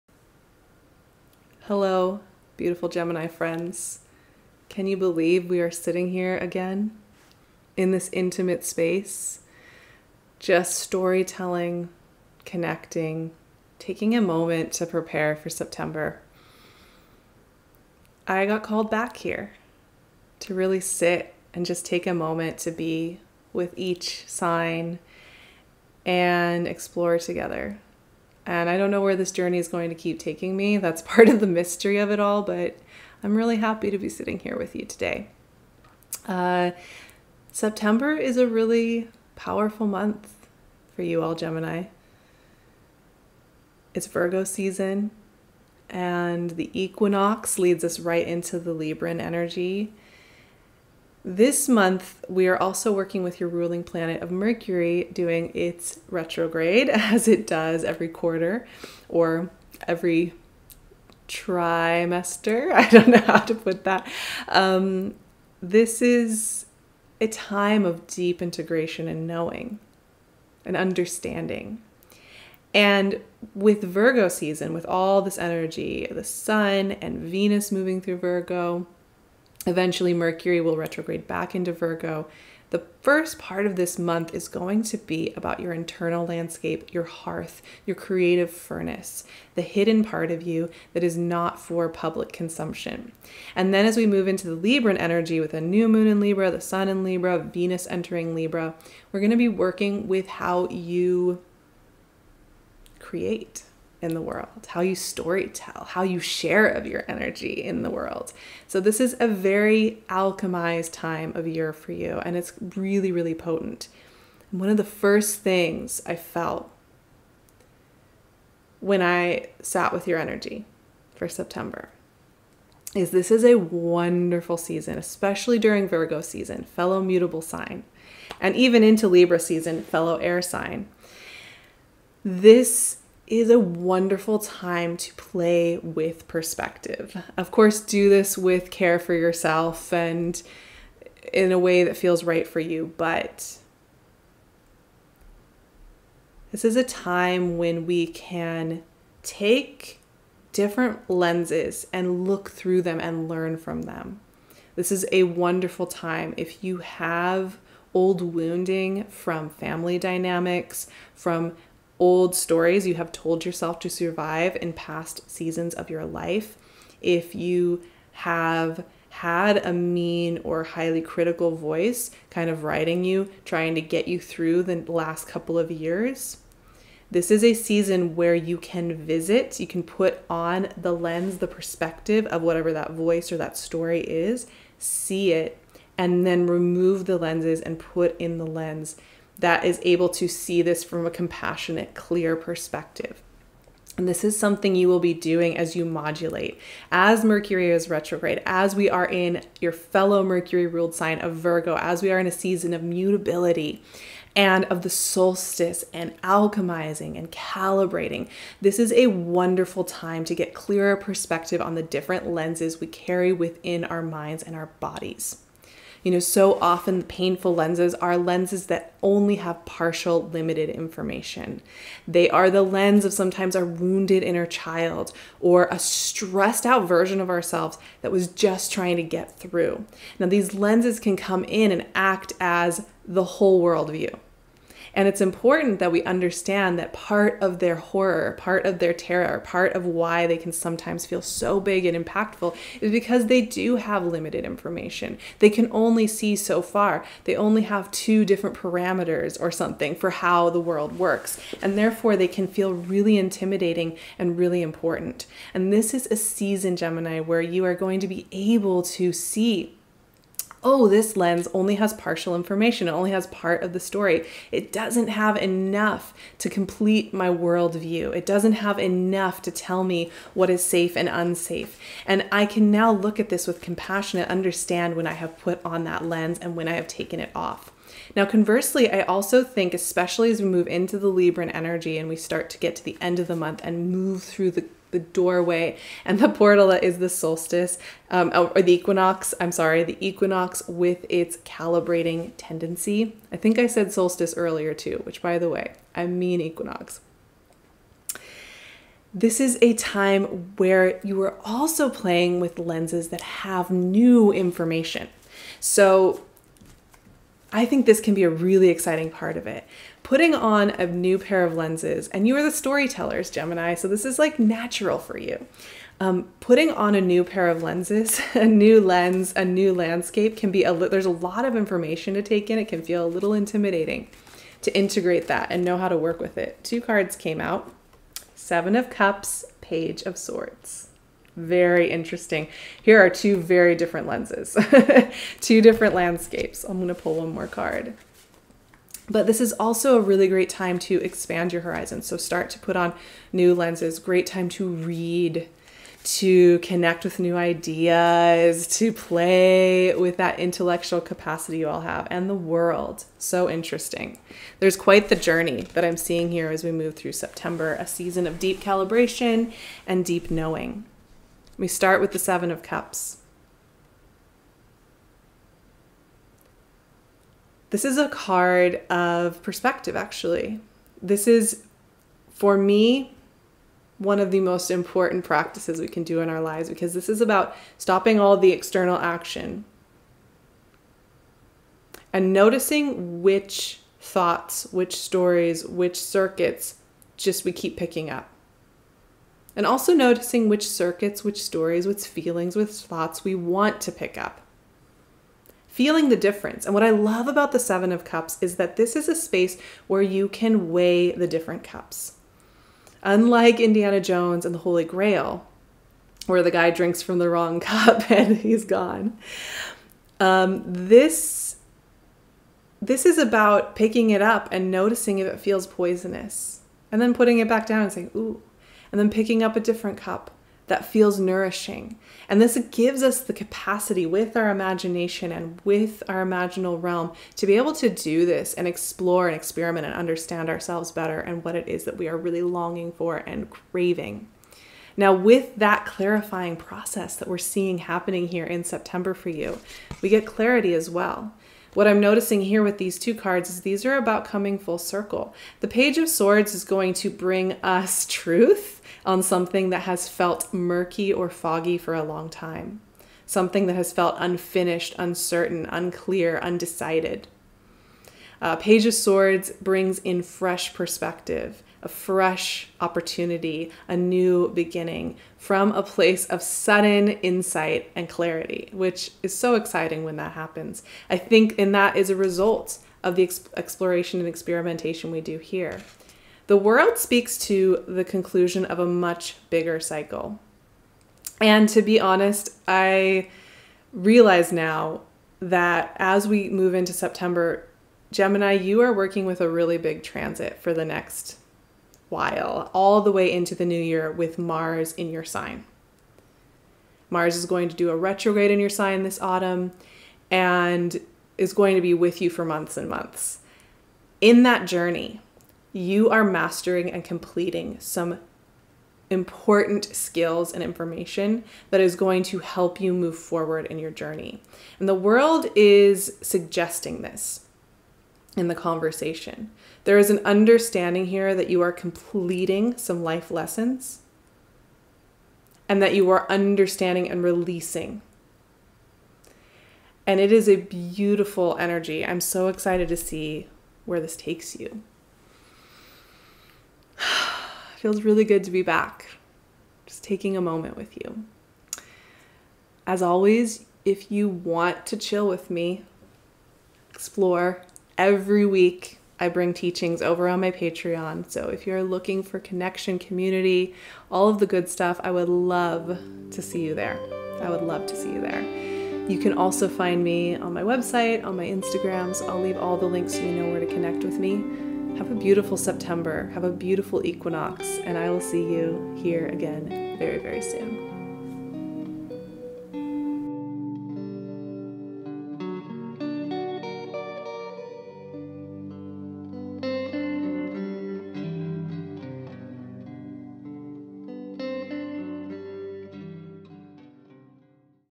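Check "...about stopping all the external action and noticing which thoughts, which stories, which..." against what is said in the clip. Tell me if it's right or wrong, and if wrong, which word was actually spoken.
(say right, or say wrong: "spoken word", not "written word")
right.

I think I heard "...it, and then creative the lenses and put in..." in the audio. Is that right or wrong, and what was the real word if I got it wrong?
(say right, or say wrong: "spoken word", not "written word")
wrong: "remove", not "creative".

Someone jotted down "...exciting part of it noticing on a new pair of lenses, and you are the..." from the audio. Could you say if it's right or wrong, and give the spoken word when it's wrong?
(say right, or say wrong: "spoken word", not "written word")
wrong: "putting", not "noticing".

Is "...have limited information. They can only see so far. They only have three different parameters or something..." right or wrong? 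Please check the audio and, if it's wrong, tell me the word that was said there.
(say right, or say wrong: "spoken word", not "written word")
wrong: "two", not "three".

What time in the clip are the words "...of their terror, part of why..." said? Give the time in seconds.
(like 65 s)
238 s.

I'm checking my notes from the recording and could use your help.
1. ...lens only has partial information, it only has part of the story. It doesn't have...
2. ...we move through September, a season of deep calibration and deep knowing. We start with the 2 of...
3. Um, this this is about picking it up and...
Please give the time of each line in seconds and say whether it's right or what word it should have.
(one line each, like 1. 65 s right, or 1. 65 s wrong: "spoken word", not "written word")
1. 261 s right
2. 356 s wrong: "7", not "2"
3. 410 s right.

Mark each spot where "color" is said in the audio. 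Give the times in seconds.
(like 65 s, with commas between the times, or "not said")
not said.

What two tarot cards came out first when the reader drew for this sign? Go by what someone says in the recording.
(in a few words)
Seven of Cups, Page of Swords.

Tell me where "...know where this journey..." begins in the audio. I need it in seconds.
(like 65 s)
28 s.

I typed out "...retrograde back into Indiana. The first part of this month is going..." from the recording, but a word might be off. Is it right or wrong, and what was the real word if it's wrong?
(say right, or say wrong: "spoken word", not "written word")
wrong: "Virgo", not "Indiana".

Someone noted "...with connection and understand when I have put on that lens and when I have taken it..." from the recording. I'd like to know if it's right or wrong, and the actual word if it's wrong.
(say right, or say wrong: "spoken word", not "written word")
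wrong: "compassion", not "connection".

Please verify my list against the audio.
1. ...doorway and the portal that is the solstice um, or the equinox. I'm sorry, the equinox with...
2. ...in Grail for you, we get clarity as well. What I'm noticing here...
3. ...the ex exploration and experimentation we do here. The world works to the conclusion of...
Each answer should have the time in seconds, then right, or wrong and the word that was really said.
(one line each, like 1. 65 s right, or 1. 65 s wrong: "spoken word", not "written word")
1. 284 s right
2. 438 s wrong: "September", not "Grail"
3. 473 s wrong: "speaks", not "works".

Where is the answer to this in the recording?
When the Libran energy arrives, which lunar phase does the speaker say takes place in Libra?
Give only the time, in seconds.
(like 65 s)
95 s.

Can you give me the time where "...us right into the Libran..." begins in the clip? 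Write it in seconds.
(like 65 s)
47 s.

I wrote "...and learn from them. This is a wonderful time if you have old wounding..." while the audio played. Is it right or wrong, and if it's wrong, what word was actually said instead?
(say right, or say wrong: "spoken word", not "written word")
right.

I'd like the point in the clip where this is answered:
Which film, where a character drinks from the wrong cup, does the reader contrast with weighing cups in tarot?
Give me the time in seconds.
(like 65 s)
403 s.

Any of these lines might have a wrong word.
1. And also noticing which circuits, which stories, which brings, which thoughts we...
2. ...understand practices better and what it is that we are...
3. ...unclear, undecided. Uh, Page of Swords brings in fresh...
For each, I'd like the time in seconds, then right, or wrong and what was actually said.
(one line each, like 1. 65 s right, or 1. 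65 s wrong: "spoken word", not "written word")
1. 389 s wrong: "feelings", not "brings"
2. 429 s wrong: "ourselves", not "practices"
3. 455 s right.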